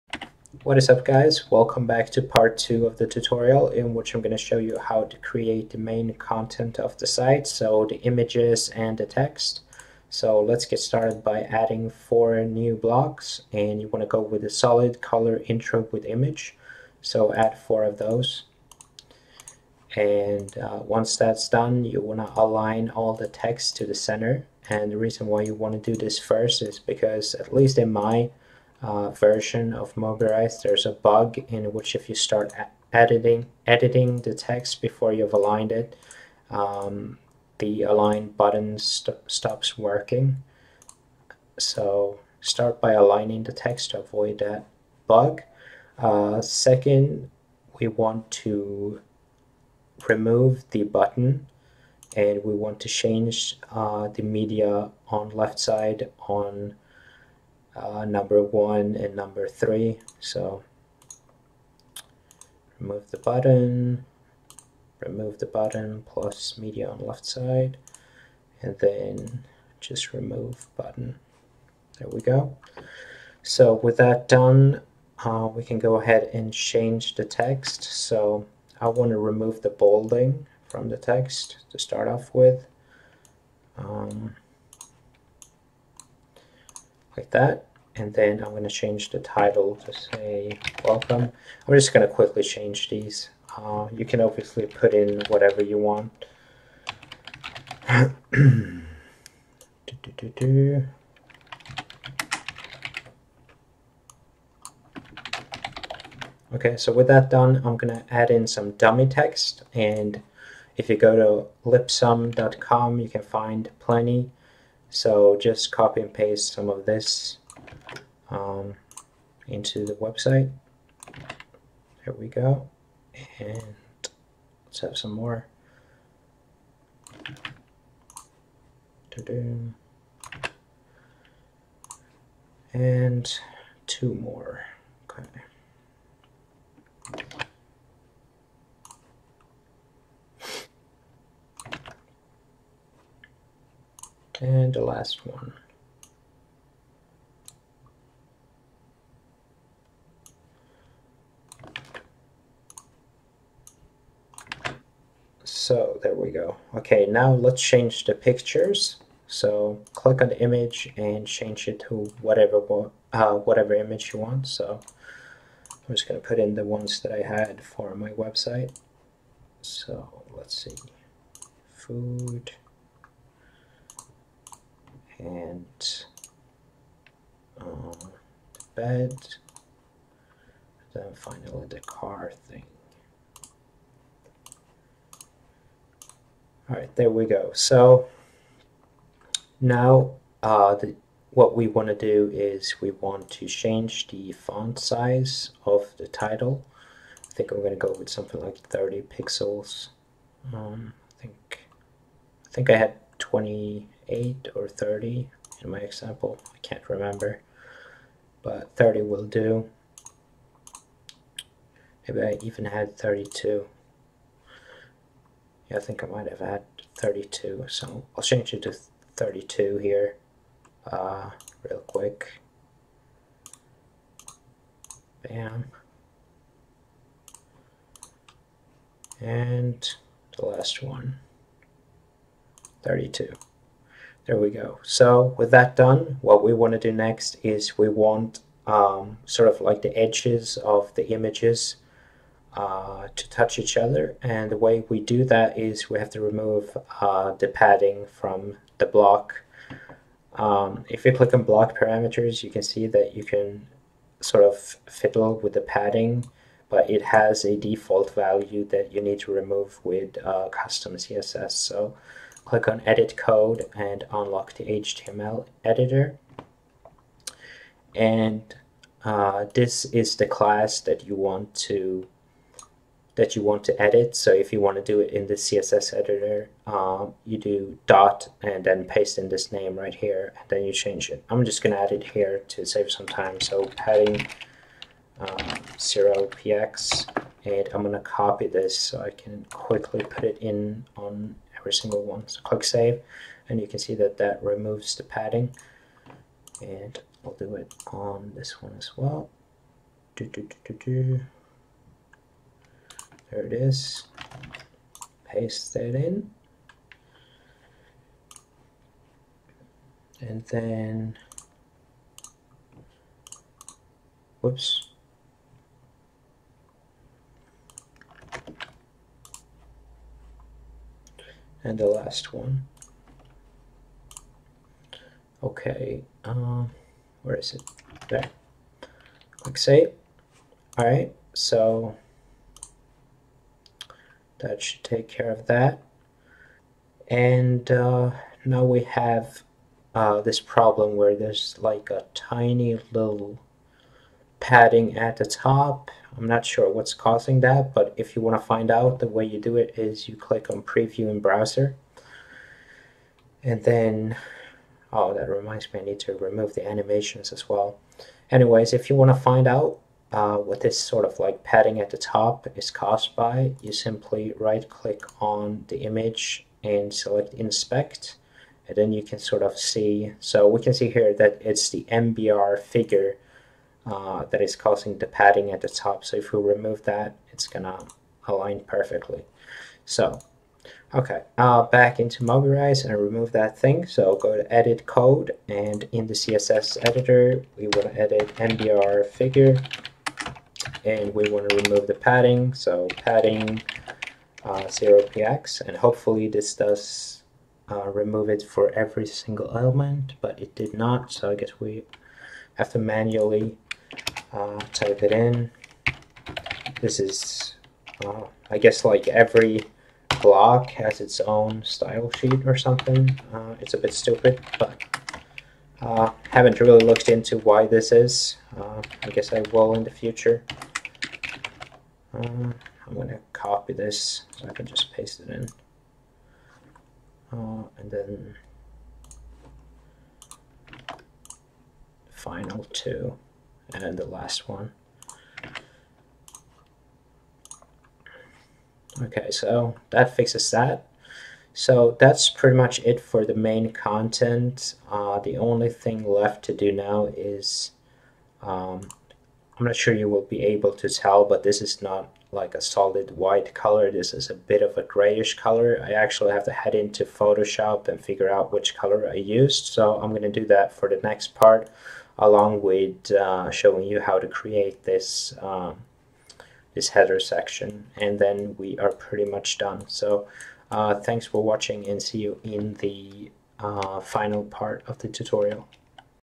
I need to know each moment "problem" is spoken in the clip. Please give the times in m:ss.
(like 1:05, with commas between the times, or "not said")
5:40.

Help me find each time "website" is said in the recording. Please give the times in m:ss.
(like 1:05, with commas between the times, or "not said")
1:59, 2:48.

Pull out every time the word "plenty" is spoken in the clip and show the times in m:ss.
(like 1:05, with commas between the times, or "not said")
1:53.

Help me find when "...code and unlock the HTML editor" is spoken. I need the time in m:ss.
4:23.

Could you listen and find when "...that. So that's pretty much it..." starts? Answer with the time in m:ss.
7:20.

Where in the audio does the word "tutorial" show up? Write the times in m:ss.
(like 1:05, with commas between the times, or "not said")
0:03, 7:55.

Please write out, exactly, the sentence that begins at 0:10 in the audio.
So let's get started by adding four new blocks and you want to go with a solid color intro with image.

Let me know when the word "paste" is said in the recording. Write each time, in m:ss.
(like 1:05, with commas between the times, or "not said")
1:56, 4:38, 5:05, 7:04.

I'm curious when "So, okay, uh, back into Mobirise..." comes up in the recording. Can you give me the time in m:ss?
6:19.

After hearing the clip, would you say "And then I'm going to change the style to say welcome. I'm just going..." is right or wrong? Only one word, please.
wrong.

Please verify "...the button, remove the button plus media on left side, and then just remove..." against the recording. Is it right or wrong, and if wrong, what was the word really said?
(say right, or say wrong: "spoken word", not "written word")
right.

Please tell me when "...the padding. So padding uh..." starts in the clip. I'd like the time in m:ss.
6:31.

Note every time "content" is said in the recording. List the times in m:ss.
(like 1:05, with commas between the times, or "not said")
0:06, 7:23.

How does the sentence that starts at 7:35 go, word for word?
I actually have to head into Photoshop and figure out which color I used.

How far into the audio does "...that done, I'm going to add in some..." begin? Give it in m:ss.
1:47.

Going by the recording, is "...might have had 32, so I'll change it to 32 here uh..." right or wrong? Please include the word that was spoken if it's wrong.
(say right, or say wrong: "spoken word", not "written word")
right.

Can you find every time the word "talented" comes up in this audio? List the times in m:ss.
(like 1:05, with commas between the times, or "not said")
not said.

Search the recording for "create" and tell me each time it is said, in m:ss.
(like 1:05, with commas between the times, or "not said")
0:05, 7:44.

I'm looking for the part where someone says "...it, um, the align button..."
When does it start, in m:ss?
0:35.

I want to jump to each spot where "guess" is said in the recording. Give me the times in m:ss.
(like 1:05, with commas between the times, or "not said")
6:41, 6:48, 6:59.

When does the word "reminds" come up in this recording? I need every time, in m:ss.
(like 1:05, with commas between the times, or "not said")
5:55.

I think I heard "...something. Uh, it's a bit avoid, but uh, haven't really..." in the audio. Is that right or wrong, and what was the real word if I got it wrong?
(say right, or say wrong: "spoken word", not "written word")
wrong: "stupid", not "avoid".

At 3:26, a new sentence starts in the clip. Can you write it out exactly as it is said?
I can't remember, but 30 will do.